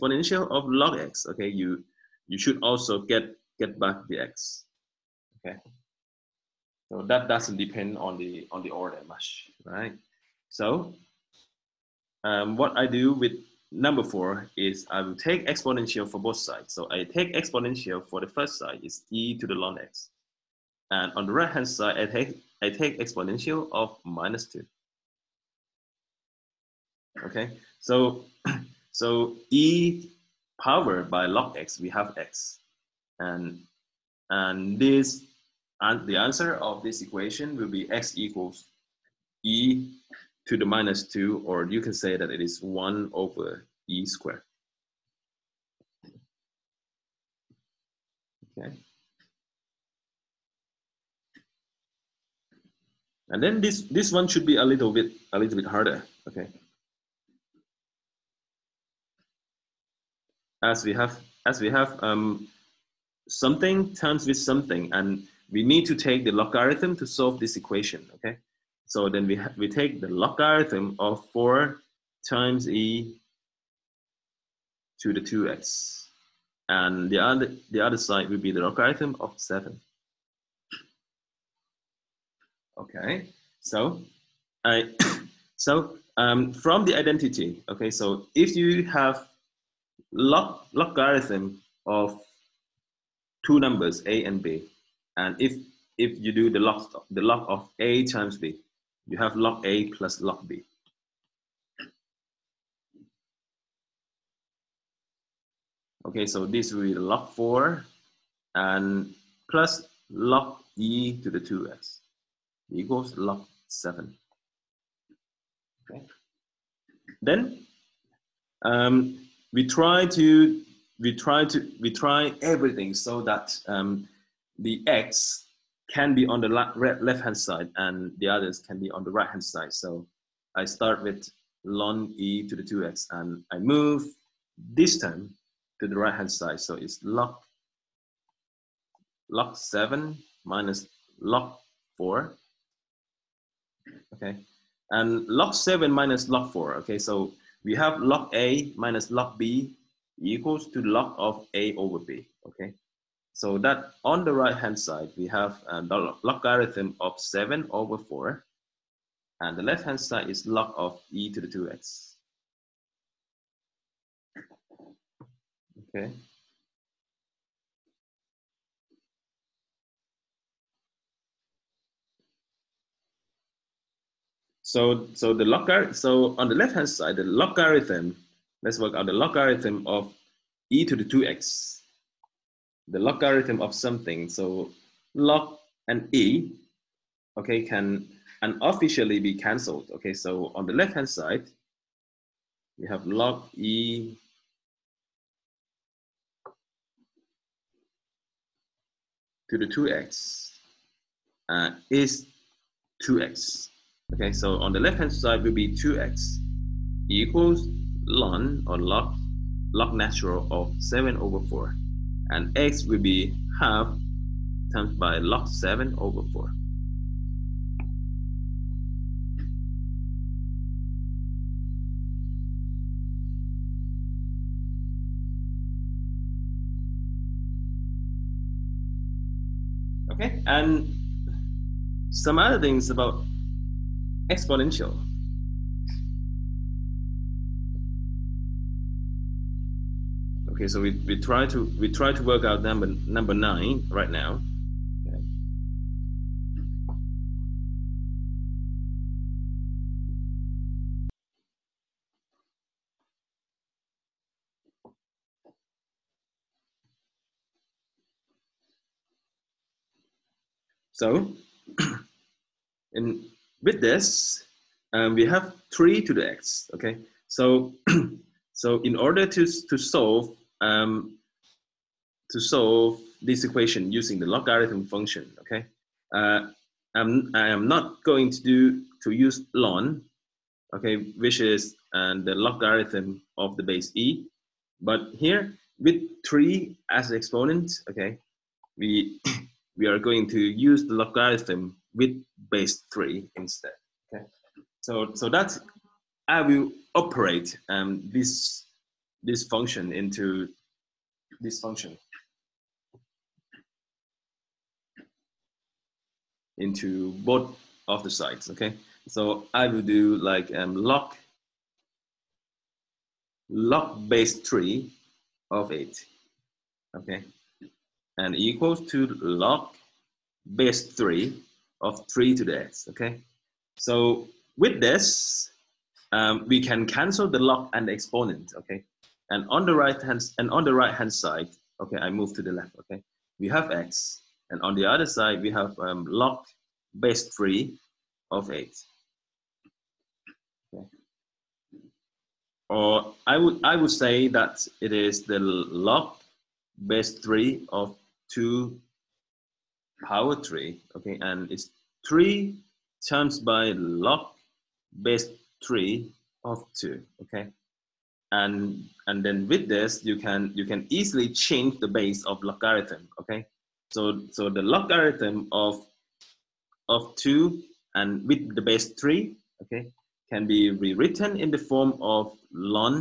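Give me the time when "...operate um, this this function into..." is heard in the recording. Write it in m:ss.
4:56.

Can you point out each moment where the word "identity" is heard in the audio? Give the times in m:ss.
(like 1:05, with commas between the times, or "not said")
1:26.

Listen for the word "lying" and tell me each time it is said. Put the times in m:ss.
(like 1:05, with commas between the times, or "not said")
not said.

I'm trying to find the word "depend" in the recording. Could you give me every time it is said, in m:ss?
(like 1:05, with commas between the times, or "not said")
0:07.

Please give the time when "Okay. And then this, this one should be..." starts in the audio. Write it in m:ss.
0:48.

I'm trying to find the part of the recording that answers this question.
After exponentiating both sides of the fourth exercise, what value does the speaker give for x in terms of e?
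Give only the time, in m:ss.
0:37.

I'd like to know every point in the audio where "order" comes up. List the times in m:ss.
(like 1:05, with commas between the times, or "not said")
0:08, 4:28.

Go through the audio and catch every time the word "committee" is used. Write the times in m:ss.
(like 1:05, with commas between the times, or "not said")
not said.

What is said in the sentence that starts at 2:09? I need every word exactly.
So I start with long e to the 2x and I move this term to the right hand side.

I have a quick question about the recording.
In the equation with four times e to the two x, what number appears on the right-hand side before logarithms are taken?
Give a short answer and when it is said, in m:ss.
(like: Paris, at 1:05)
7, at 1:18.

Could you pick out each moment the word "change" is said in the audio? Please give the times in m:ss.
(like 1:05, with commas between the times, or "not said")
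6:01.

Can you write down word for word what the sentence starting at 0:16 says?
So I take exponential for the first side is e to the log x.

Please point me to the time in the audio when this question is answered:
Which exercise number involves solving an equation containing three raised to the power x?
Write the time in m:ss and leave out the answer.
4:03.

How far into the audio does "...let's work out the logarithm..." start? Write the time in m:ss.
2:58.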